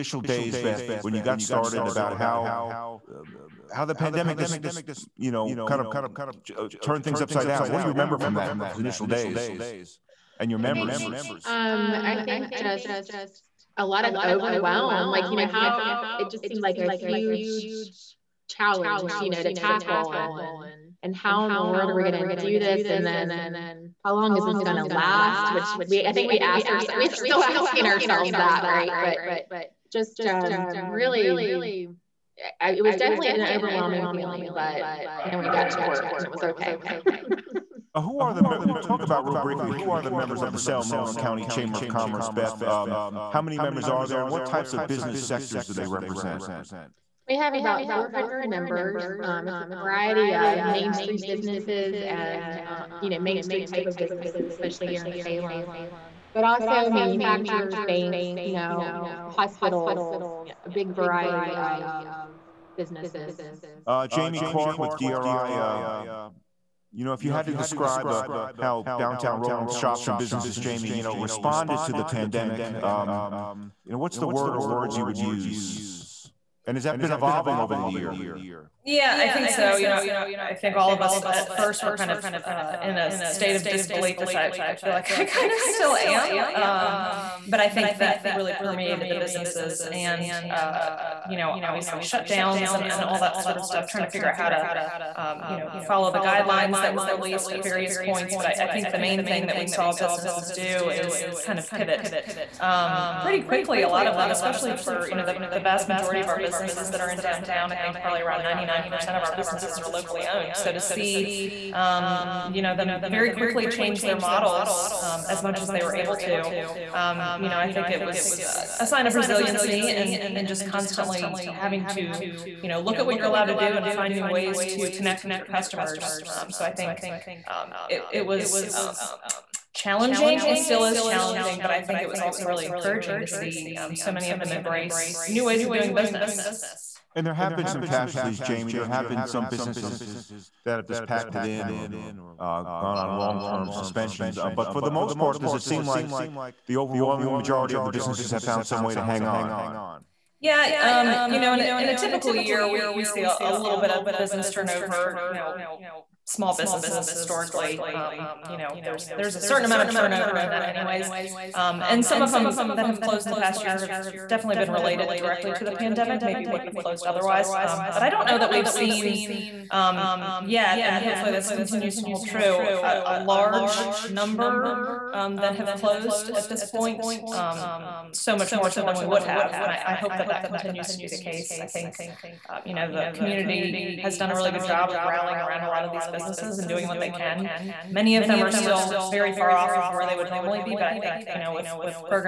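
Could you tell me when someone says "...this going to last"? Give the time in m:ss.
0:24.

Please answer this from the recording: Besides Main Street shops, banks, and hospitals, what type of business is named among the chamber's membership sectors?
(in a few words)
manufacturers.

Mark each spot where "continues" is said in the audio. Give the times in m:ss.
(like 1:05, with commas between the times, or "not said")
2:51, 3:00.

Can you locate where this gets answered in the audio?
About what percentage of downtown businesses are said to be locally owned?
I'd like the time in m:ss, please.
1:48.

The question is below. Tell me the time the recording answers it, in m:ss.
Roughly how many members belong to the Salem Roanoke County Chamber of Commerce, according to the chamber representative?
0:47.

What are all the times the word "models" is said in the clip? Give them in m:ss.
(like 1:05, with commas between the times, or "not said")
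1:54.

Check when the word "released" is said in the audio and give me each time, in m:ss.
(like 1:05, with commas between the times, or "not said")
1:37.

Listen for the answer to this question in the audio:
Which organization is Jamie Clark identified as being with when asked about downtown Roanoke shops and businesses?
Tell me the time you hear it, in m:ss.
1:04.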